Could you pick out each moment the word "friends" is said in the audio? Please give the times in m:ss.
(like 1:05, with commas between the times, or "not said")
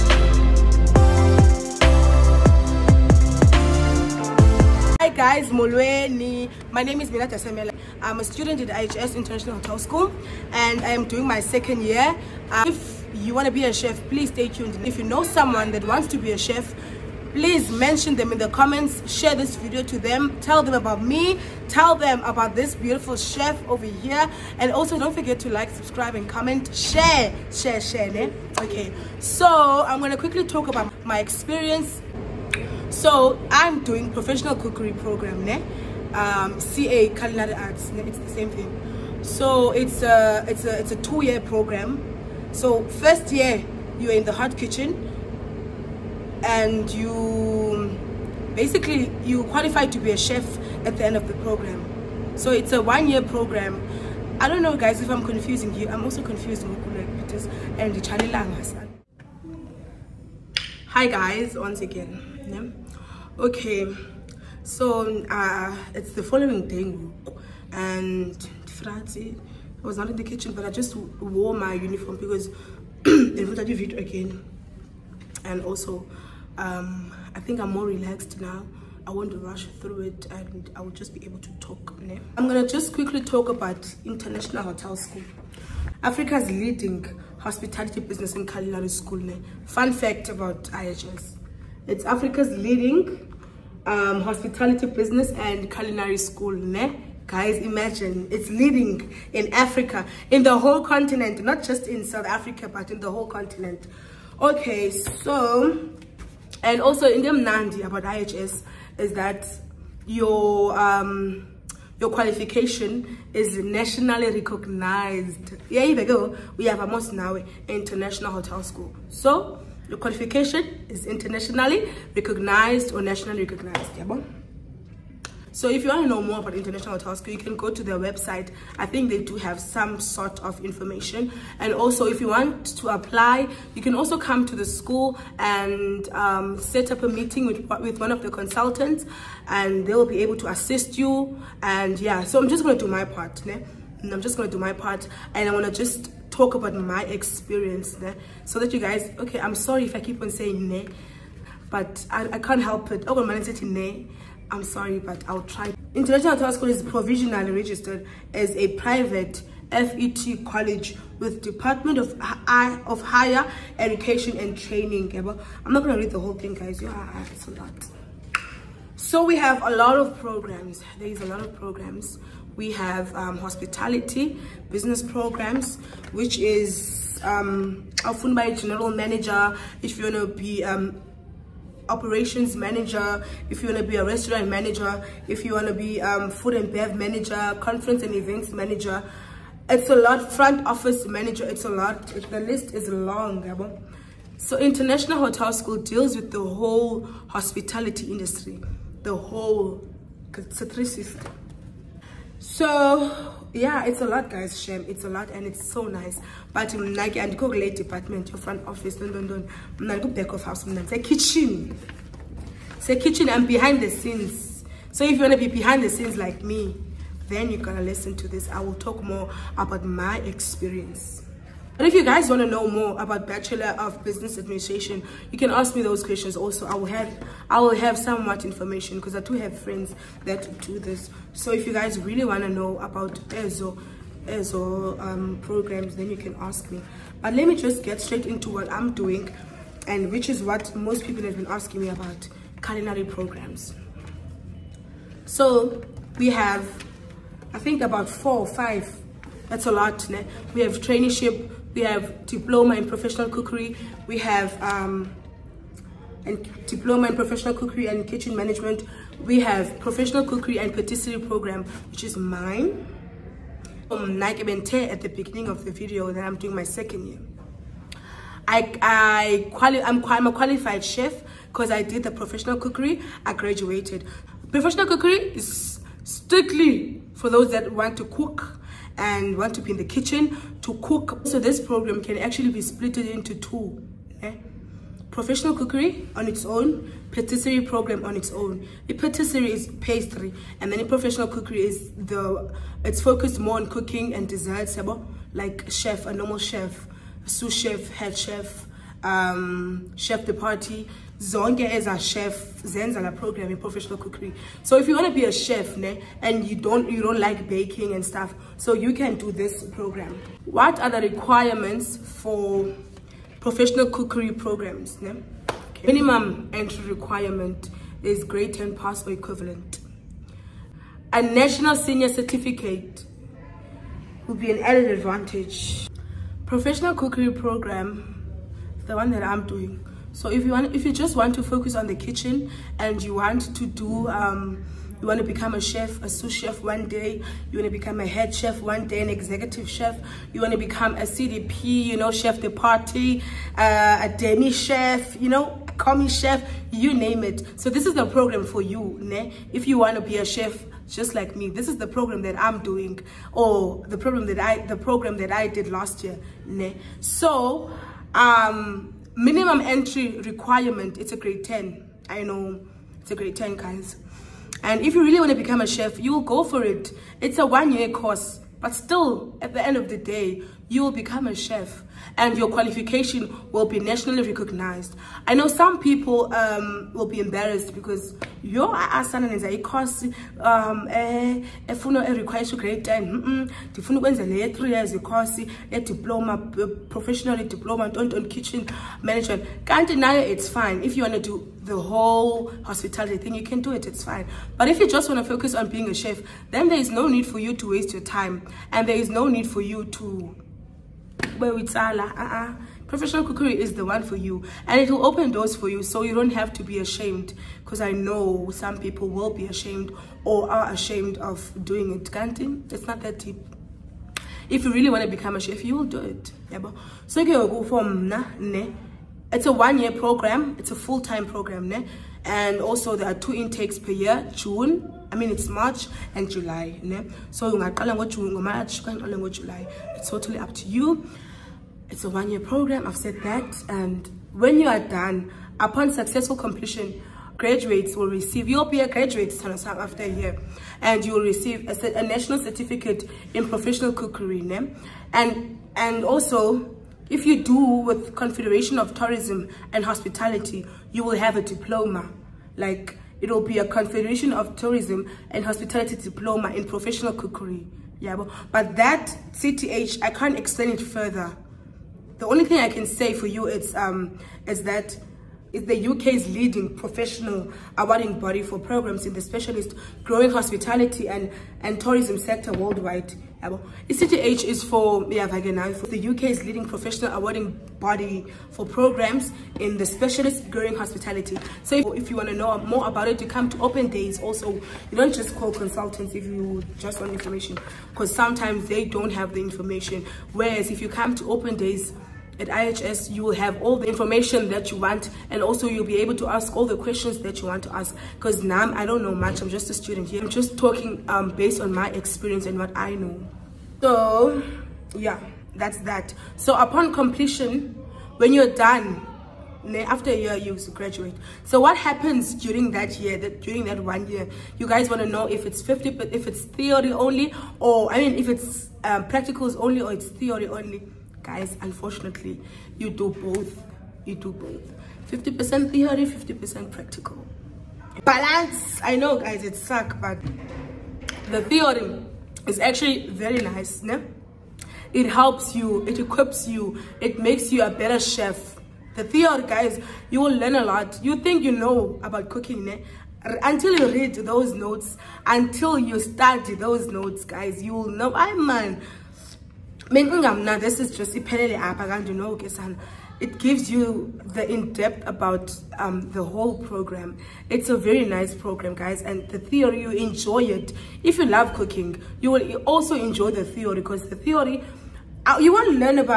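3:49.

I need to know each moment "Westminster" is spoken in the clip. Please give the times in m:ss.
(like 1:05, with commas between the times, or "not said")
not said.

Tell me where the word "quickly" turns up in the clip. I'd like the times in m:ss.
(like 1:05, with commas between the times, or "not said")
0:30, 1:22.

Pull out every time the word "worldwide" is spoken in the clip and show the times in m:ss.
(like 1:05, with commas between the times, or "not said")
7:52.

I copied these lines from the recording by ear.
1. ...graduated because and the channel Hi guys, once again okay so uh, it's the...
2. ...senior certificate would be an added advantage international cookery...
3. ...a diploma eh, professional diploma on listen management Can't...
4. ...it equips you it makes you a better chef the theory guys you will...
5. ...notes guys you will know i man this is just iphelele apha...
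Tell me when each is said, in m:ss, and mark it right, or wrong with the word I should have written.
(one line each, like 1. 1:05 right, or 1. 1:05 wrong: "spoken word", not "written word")
1. 0:56 wrong: "confused", not "graduated"
2. 5:21 wrong: "professional", not "international"
3. 6:25 wrong: "kitchen", not "listen"
4. 8:55 right
5. 9:06 right.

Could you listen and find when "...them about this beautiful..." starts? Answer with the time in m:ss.
0:21.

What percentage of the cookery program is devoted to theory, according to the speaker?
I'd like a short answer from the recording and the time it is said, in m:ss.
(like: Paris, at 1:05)
50%, at 8:45.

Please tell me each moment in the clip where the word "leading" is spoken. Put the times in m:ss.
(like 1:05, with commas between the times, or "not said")
1:26, 1:32, 1:38, 7:46, 7:56.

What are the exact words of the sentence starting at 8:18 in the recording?
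Because now I don't know much, I'm just a student here.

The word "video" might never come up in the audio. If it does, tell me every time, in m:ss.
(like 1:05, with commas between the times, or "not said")
0:19, 4:25.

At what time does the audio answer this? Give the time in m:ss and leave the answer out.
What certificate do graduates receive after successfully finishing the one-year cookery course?
7:22.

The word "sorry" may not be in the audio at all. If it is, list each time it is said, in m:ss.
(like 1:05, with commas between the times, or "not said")
2:29, 2:34.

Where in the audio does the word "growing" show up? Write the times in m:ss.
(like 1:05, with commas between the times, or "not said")
7:50, 8:00.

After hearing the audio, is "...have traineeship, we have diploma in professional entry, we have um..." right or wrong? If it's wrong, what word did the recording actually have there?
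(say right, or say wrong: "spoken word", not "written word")
wrong: "cookery", not "entry".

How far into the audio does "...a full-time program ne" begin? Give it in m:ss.
7:00.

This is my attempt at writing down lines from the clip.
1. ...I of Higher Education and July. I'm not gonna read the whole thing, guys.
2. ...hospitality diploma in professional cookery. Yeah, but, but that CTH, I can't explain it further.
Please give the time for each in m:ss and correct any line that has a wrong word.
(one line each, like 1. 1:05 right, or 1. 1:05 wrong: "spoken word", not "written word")
1. 2:42 wrong: "Training", not "July"
2. 7:35 right.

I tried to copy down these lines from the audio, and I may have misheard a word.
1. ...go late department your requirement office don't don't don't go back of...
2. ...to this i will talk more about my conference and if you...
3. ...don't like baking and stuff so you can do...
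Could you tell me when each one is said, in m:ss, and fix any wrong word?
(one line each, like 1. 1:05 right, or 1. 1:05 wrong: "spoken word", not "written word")
1. 3:27 wrong: "front", not "requirement"
2. 3:38 wrong: "experience", not "conference"
3. 5:07 right.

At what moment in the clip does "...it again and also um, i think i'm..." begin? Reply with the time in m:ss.
1:13.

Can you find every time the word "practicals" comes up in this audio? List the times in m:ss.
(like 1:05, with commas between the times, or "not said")
8:39, 8:46.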